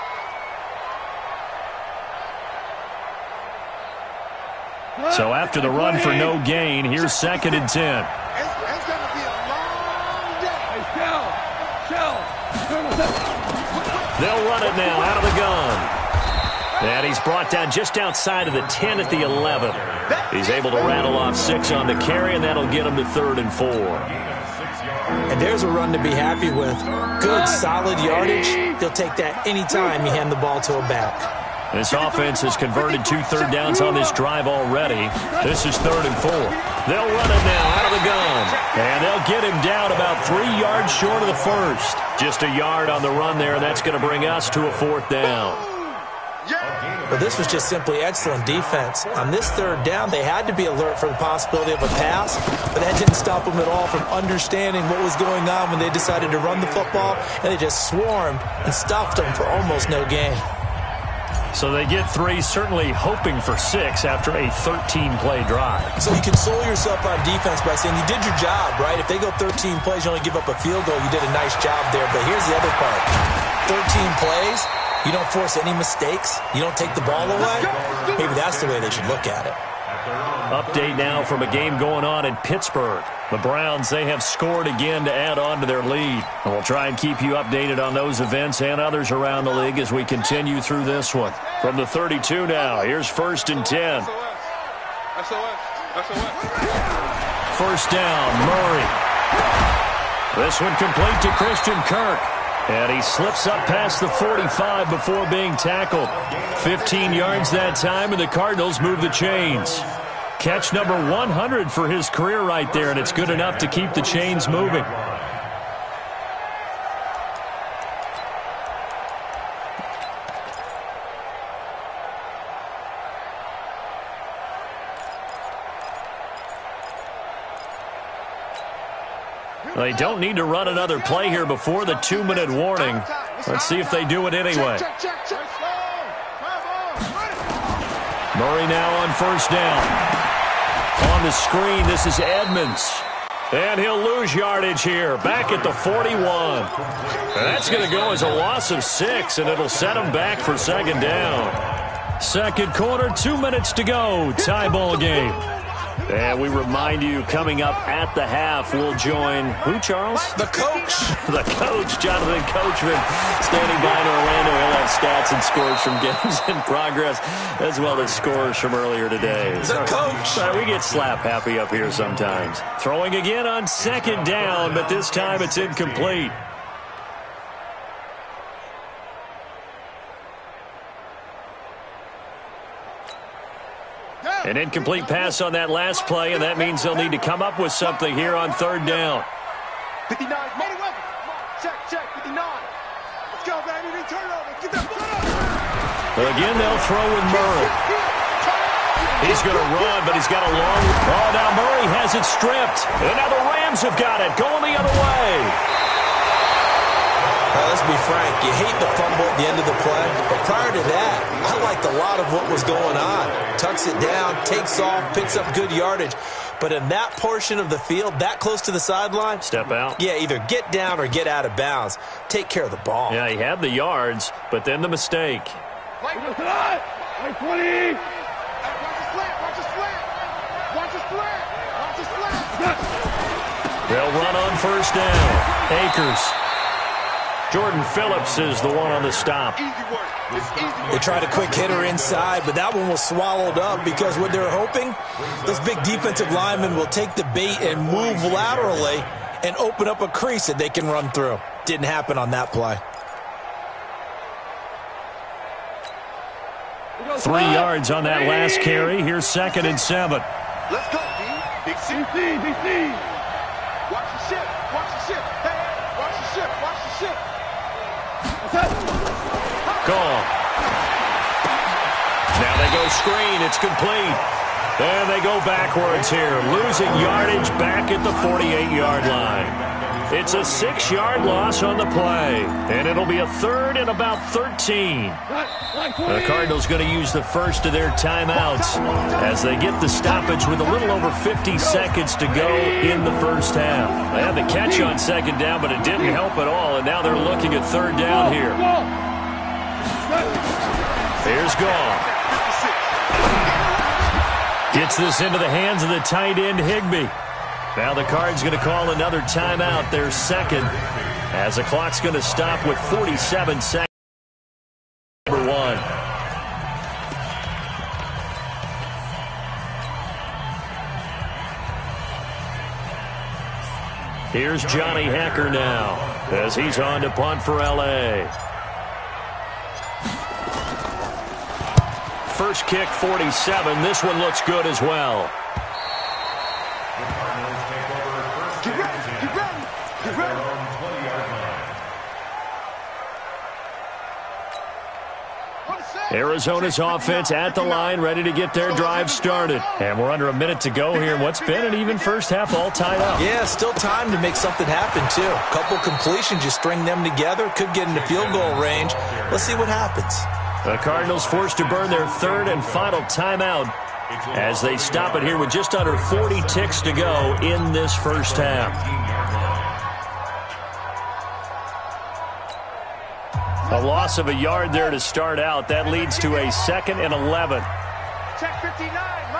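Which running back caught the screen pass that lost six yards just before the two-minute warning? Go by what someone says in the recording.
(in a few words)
Edmonds.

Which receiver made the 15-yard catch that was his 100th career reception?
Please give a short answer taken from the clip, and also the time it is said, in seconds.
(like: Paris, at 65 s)
Christian Kirk, at 101 s.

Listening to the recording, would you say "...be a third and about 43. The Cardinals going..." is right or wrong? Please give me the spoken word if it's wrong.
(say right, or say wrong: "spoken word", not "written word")
wrong: "13", not "43".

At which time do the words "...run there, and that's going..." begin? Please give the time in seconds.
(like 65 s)
43 s.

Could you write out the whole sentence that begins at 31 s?
This offense has converted two third downs on this drive already.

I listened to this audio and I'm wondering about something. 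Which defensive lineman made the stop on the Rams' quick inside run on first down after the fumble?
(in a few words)
Jordan Phillips.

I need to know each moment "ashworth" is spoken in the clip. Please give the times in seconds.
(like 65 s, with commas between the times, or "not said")
not said.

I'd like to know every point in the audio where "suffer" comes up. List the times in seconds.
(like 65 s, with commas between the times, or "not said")
not said.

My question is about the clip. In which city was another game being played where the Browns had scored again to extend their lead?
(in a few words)
Pittsburgh.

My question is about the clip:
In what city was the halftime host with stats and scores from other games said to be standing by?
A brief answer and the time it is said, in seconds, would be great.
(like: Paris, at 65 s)
Orlando, at 164 s.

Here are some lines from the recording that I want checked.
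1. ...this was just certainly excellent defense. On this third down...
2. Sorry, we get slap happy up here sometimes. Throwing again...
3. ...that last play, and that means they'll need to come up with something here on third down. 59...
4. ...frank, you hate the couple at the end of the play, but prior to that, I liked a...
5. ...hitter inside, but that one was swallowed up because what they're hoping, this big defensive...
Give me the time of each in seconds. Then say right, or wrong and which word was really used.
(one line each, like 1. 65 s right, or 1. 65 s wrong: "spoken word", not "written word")
1. 47 s wrong: "simply", not "certainly"
2. 170 s right
3. 185 s right
4. 208 s wrong: "fumble", not "couple"
5. 241 s right.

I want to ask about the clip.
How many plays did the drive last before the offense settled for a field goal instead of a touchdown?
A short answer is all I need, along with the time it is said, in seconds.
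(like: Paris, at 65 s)
13, at 64 s.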